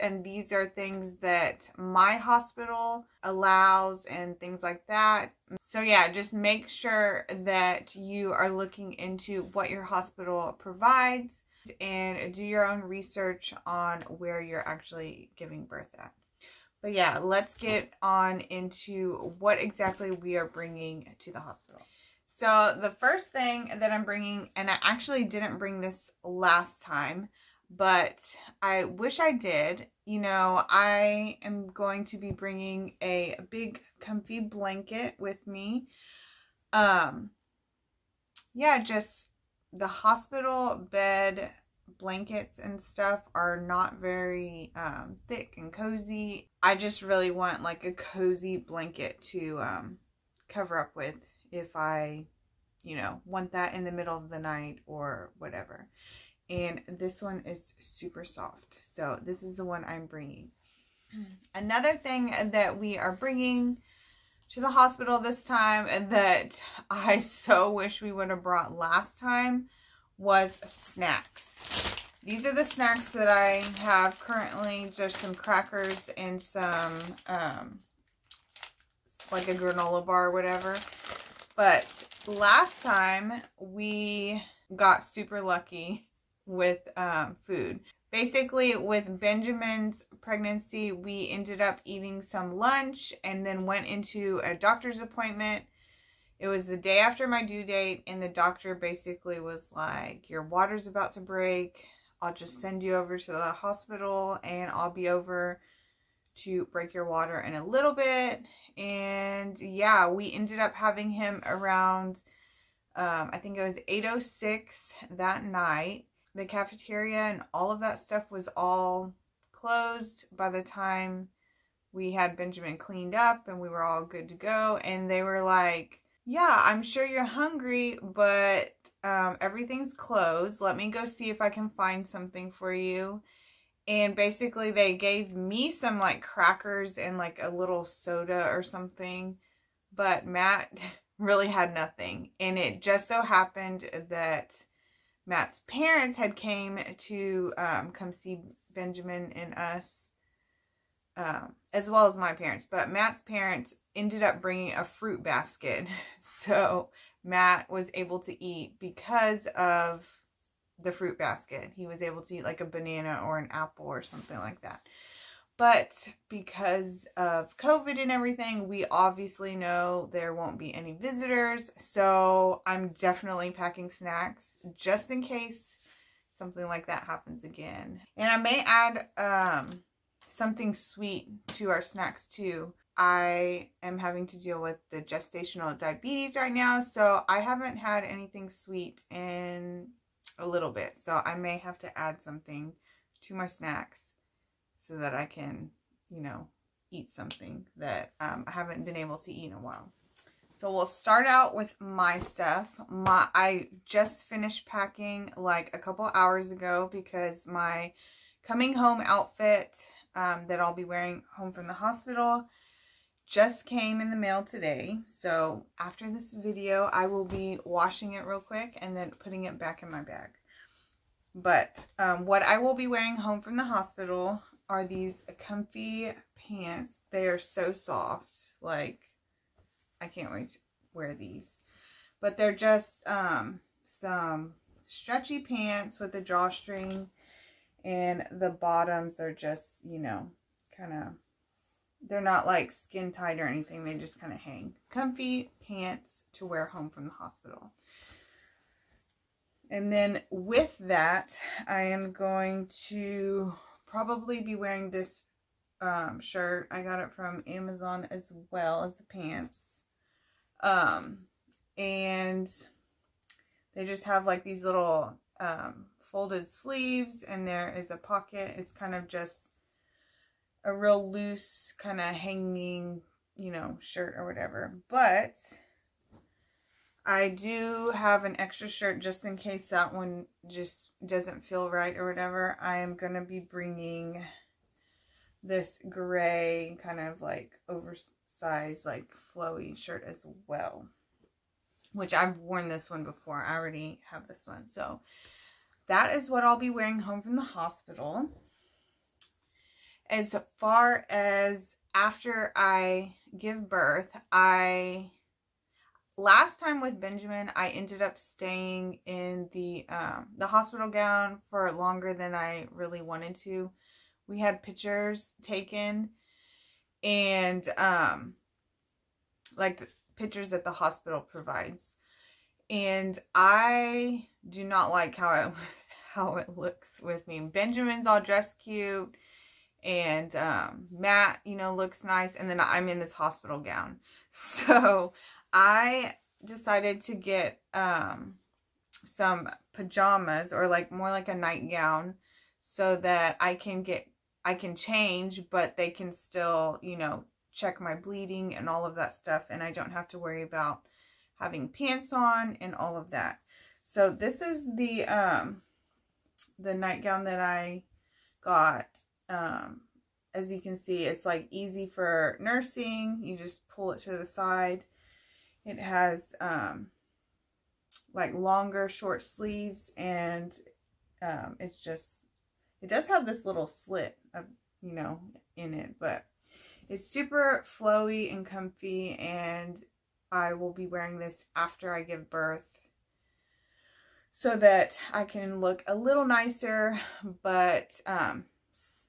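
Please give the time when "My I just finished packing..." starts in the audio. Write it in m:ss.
3:22.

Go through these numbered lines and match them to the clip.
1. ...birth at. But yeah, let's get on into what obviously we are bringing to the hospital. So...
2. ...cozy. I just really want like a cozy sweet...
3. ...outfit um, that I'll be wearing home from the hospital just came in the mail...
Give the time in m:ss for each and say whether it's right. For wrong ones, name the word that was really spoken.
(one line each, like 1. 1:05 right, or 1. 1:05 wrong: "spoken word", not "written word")
1. 0:15 wrong: "exactly", not "obviously"
2. 0:45 wrong: "blanket", not "sweet"
3. 3:29 right.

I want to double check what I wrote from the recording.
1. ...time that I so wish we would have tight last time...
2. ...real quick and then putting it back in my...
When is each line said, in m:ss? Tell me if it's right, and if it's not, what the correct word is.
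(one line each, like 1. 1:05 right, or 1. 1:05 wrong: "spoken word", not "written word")
1. 1:05 wrong: "brought", not "tight"
2. 3:38 right.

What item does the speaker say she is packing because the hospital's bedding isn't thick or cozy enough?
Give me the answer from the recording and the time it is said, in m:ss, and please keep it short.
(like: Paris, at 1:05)
big comfy blanket, at 0:33.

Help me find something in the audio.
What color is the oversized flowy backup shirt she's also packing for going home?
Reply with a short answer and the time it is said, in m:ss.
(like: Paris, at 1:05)
gray, at 4:45.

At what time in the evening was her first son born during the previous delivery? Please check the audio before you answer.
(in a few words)
8:06.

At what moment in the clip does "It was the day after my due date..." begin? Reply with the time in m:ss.
1:36.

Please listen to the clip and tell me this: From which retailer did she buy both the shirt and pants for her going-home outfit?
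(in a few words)
Amazon.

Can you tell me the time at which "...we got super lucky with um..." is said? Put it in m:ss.
1:23.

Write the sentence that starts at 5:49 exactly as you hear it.
And I don't have to worry about having pants on and all of that.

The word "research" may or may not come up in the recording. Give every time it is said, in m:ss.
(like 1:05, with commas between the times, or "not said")
0:12.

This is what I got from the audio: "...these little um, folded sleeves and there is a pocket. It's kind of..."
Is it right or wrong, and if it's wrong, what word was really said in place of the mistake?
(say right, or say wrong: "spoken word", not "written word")
right.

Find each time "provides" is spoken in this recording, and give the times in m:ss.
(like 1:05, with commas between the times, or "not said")
0:10, 5:21.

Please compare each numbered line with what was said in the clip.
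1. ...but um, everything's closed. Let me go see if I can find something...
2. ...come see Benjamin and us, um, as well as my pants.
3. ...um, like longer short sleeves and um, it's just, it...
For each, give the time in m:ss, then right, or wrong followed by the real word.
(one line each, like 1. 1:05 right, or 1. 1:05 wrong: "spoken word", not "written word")
1. 2:08 right
2. 2:27 wrong: "parents", not "pants"
3. 6:06 right.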